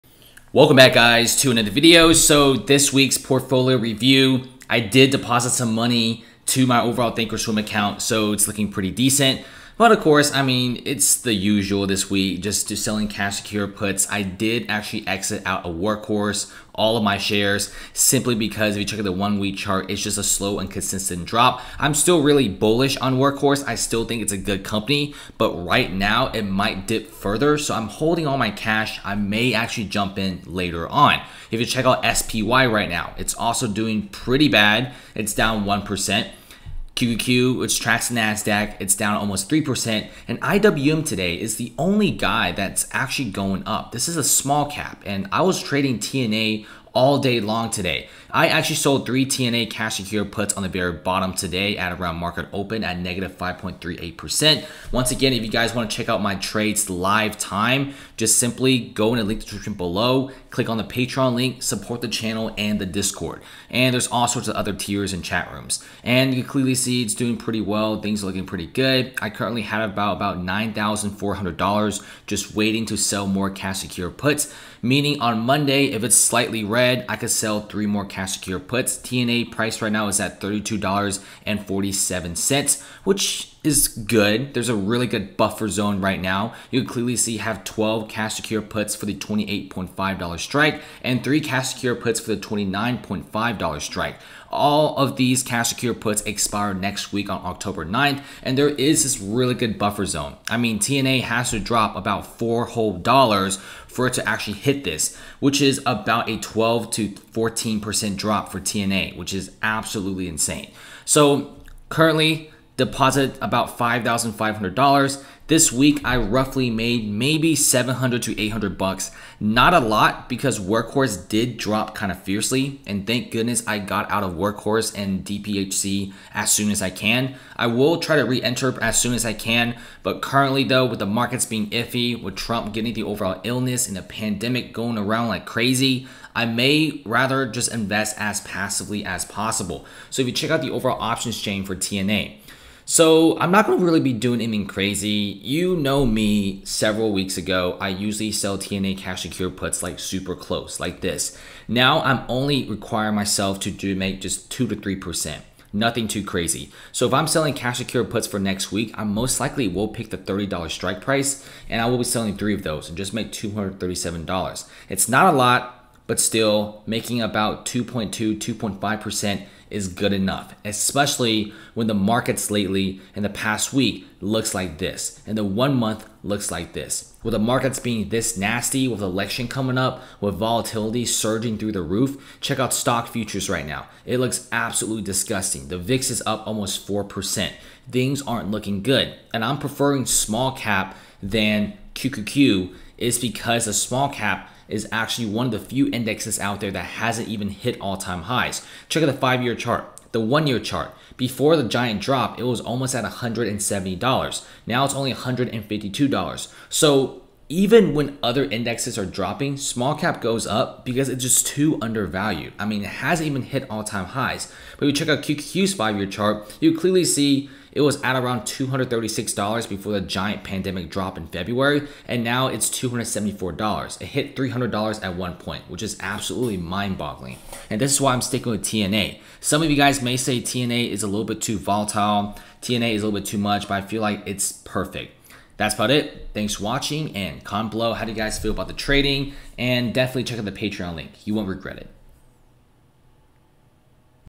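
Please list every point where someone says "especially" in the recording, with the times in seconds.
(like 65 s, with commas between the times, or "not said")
170 s.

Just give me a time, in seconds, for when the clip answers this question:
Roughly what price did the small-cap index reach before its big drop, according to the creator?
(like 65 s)
203 s.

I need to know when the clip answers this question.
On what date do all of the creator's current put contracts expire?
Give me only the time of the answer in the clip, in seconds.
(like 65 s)
97 s.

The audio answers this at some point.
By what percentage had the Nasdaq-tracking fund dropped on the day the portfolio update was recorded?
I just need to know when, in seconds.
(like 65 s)
39 s.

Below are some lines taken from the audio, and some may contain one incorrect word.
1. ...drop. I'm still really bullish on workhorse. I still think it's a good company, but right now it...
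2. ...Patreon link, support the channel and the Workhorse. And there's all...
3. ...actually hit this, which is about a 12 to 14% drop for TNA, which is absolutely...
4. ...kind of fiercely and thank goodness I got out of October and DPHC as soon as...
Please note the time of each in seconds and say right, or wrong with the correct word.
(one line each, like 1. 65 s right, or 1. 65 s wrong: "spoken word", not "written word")
1. 21 s right
2. 60 s wrong: "Discord", not "Workhorse"
3. 104 s right
4. 121 s wrong: "Workhorse", not "October".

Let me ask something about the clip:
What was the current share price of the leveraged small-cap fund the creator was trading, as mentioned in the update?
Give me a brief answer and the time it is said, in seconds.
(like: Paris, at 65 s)
$32.47, at 80 s.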